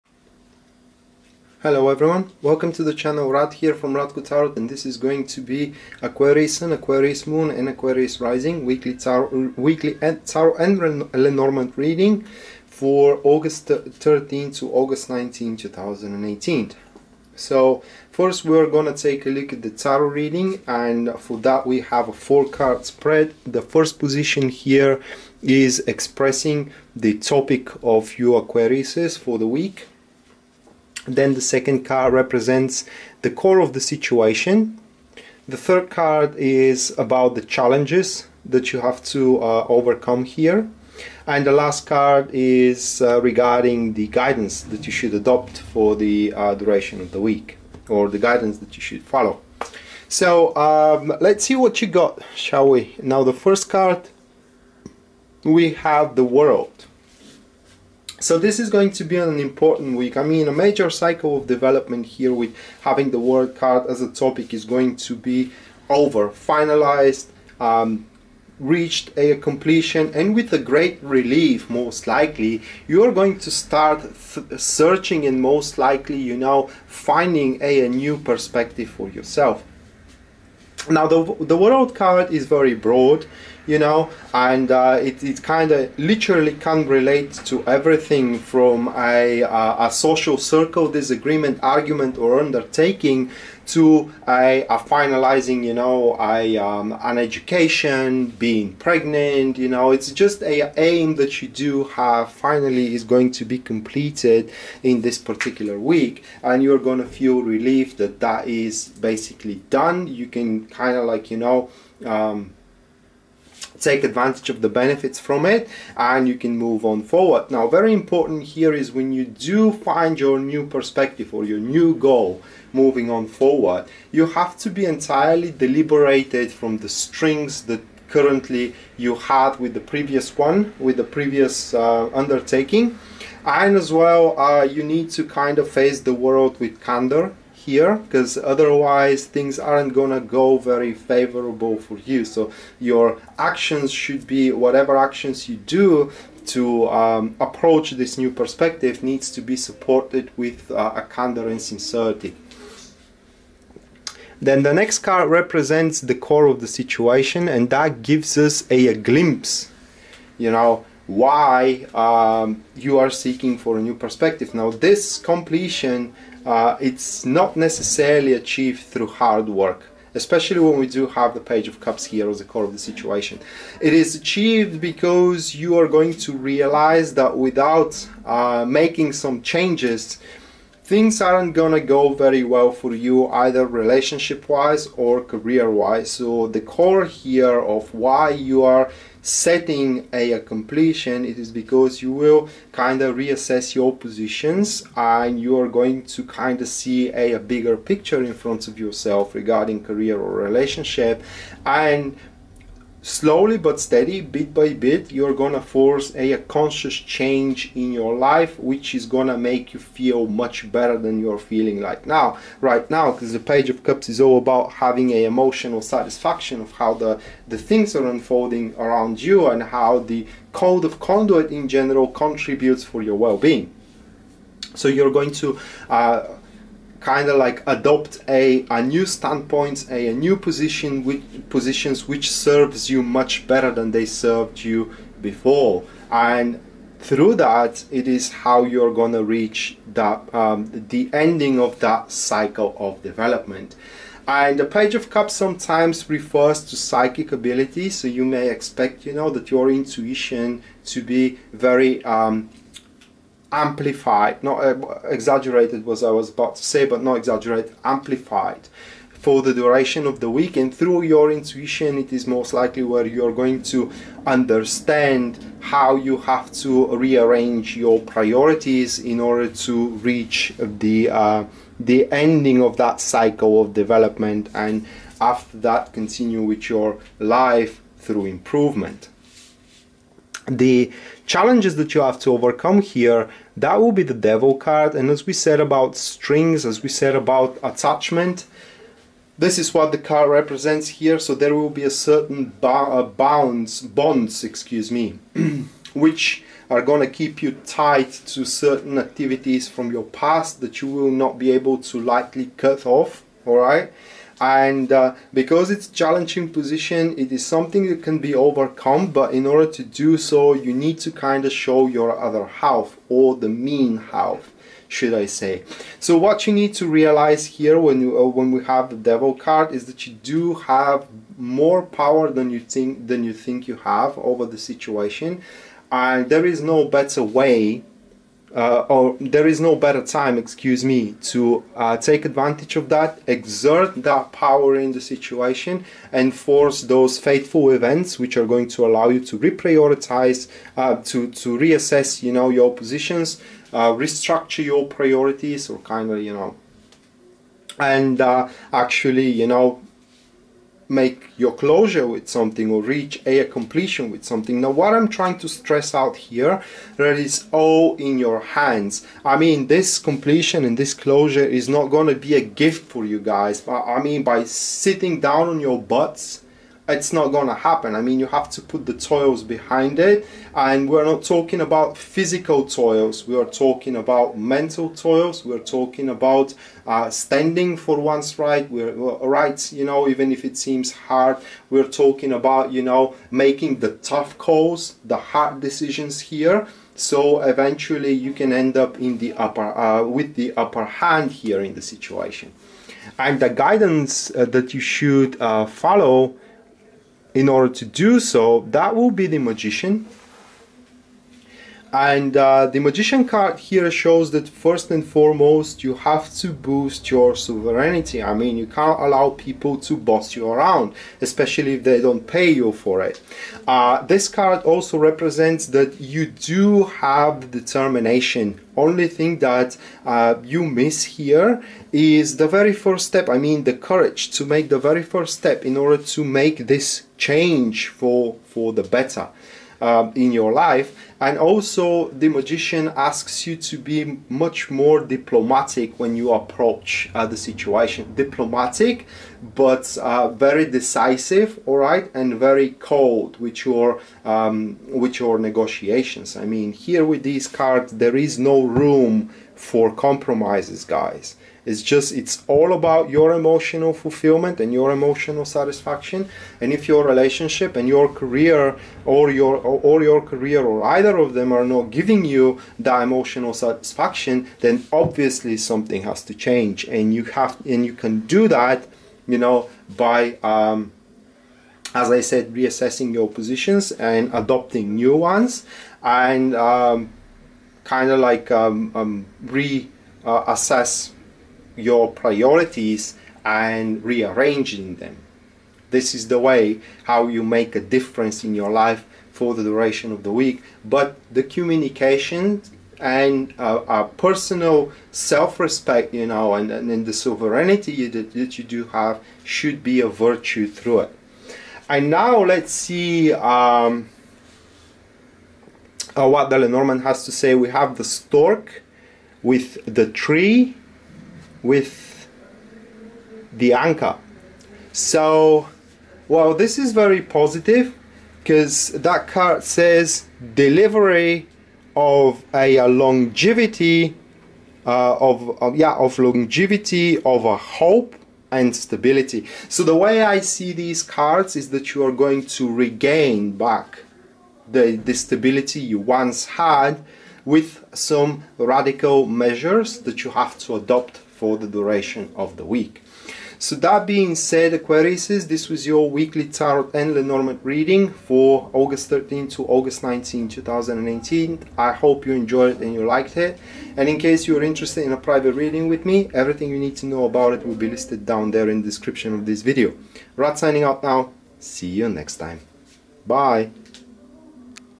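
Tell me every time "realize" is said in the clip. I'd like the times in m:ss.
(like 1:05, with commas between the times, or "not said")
2:56, 5:16.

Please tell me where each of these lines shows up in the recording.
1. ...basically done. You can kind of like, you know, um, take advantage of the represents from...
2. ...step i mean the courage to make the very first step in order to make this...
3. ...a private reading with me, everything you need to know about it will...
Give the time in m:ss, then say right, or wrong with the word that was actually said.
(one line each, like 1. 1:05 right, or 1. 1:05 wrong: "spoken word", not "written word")
1. 1:48 wrong: "benefits", not "represents"
2. 7:03 right
3. 9:15 right.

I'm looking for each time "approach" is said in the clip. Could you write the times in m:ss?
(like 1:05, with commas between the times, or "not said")
2:27, 7:16.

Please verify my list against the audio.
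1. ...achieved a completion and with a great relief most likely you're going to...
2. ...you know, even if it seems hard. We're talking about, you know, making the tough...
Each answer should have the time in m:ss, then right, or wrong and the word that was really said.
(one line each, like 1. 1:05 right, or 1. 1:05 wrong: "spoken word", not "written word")
1. 1:08 wrong: "reached", not "achieved"
2. 6:19 right.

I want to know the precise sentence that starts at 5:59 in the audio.
I mean this completion and this closure is not going to be a gift for you guys.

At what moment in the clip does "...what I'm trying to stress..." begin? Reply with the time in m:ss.
5:54.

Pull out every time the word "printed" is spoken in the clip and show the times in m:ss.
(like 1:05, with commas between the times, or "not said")
not said.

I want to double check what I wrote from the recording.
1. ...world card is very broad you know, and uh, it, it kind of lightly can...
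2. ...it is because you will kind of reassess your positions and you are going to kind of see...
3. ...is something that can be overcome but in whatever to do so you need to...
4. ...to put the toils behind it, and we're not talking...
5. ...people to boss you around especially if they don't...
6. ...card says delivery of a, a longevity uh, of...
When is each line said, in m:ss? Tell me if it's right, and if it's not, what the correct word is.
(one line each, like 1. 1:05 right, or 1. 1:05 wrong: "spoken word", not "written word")
1. 1:21 wrong: "literally", not "lightly"
2. 3:11 right
3. 5:07 wrong: "order", not "whatever"
4. 6:08 right
5. 6:49 right
6. 8:39 right.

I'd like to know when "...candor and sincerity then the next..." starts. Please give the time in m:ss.
2:31.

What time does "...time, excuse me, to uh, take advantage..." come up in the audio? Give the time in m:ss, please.
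5:30.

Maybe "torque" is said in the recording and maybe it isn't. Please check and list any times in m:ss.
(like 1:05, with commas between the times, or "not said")
not said.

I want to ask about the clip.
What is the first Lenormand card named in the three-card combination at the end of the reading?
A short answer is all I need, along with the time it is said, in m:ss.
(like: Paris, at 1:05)
The Stork, at 8:27.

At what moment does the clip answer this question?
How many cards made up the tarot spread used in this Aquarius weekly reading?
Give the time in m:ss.
0:22.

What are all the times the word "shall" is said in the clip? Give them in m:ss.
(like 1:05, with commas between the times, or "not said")
0:52.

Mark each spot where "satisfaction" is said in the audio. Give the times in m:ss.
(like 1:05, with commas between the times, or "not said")
3:35, 7:35, 7:43.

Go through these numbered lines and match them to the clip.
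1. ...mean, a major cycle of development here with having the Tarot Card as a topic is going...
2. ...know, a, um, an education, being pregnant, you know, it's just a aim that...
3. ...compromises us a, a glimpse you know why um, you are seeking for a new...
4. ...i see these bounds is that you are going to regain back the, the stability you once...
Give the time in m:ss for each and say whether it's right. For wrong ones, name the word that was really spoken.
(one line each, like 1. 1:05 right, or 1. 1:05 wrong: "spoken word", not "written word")
1. 1:00 wrong: "World", not "Tarot"
2. 1:35 right
3. 2:38 wrong: "gives", not "compromises"
4. 8:50 wrong: "cards", not "bounds".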